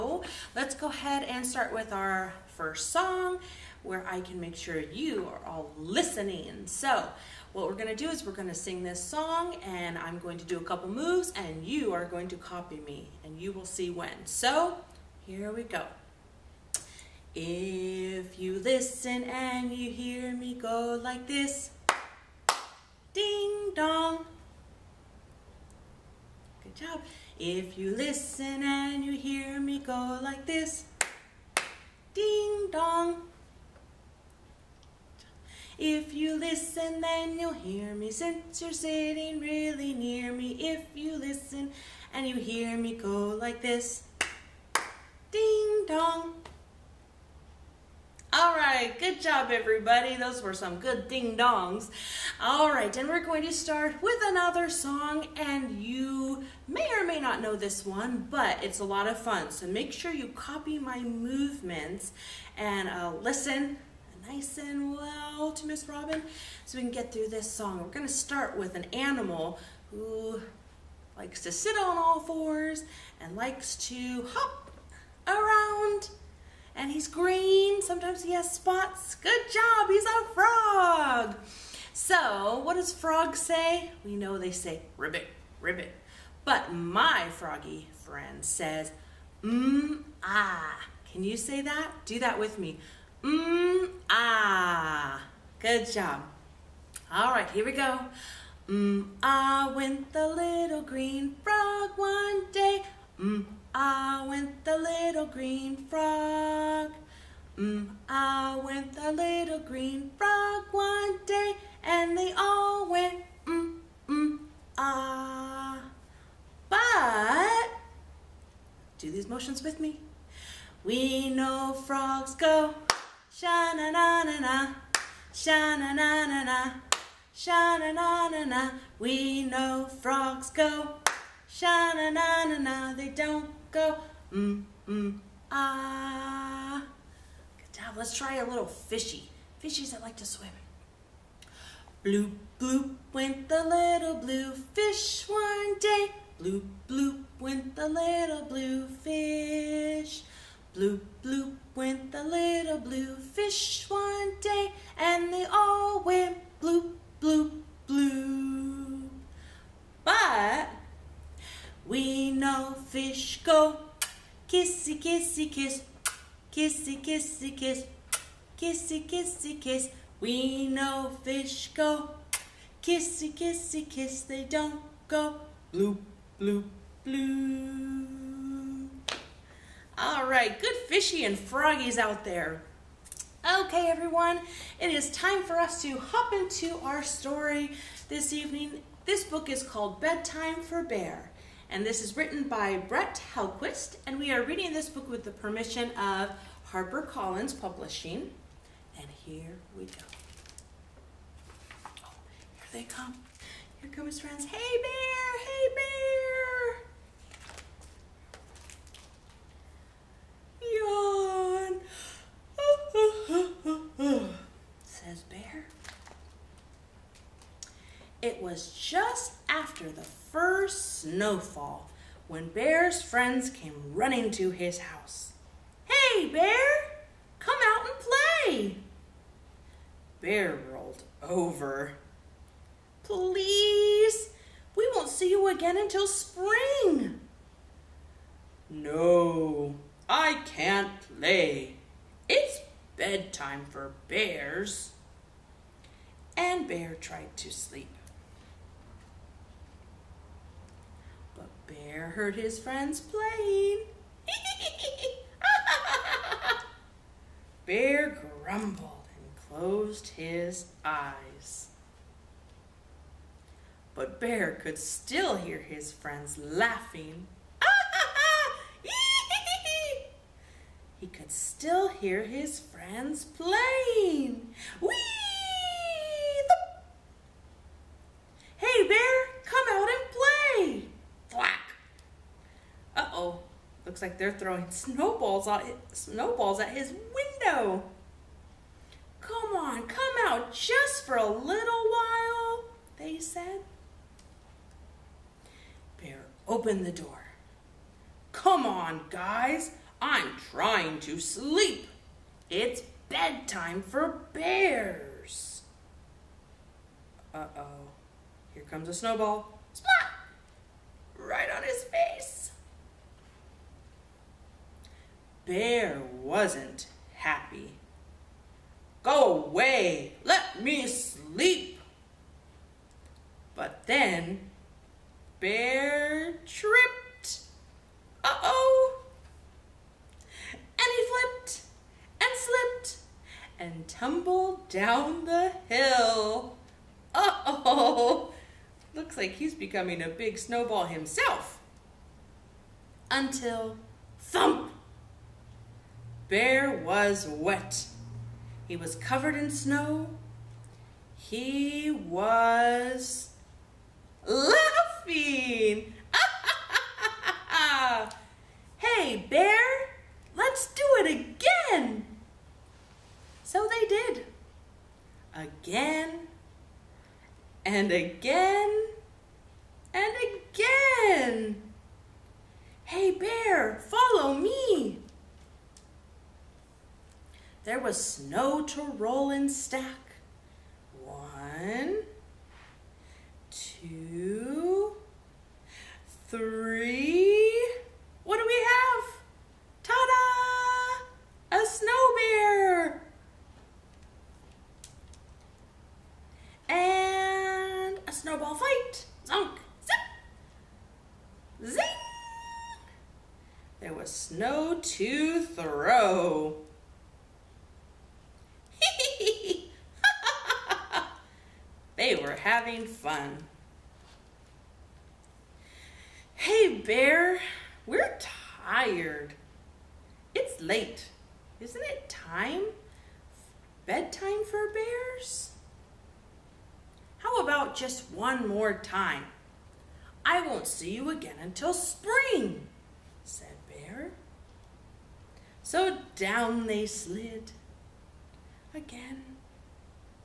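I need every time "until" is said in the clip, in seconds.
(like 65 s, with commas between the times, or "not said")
235 s, 343 s, 431 s.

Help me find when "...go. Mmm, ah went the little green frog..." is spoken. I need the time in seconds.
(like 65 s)
97 s.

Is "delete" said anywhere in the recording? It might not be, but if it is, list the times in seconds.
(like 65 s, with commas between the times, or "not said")
not said.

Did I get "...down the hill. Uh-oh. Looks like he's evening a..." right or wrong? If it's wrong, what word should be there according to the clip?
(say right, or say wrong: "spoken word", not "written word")
wrong: "becoming", not "evening".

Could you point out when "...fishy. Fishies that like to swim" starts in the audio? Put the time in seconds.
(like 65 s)
138 s.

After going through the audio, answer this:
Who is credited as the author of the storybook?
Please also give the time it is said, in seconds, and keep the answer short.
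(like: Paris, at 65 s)
Brett Helquist, at 192 s.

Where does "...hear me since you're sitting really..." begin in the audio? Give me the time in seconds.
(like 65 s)
37 s.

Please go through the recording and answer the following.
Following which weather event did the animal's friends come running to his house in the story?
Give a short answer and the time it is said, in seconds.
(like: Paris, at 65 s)
the first snowfall, at 219 s.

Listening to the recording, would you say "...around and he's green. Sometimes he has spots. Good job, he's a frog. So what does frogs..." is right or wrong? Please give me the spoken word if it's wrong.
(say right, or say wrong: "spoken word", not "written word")
right.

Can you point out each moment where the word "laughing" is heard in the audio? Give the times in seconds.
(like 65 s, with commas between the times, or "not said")
266 s, 354 s.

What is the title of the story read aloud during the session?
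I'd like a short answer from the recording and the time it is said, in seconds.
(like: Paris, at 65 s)
Bedtime for Bear, at 189 s.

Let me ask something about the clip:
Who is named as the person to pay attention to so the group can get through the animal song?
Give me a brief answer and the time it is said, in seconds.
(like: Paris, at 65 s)
Miss Robin, at 65 s.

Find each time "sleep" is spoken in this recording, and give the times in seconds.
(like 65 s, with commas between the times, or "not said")
247 s, 301 s, 320 s.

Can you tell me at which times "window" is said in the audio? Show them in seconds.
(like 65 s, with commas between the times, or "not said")
287 s.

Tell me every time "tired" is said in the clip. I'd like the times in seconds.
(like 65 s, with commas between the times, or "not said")
418 s.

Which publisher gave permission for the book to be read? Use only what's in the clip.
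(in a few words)
HarperCollins.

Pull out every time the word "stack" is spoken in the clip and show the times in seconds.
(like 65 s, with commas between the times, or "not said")
379 s.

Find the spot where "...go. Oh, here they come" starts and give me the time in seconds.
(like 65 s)
199 s.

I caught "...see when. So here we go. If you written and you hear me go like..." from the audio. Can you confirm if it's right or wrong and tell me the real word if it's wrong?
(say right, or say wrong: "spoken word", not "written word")
wrong: "listen", not "written".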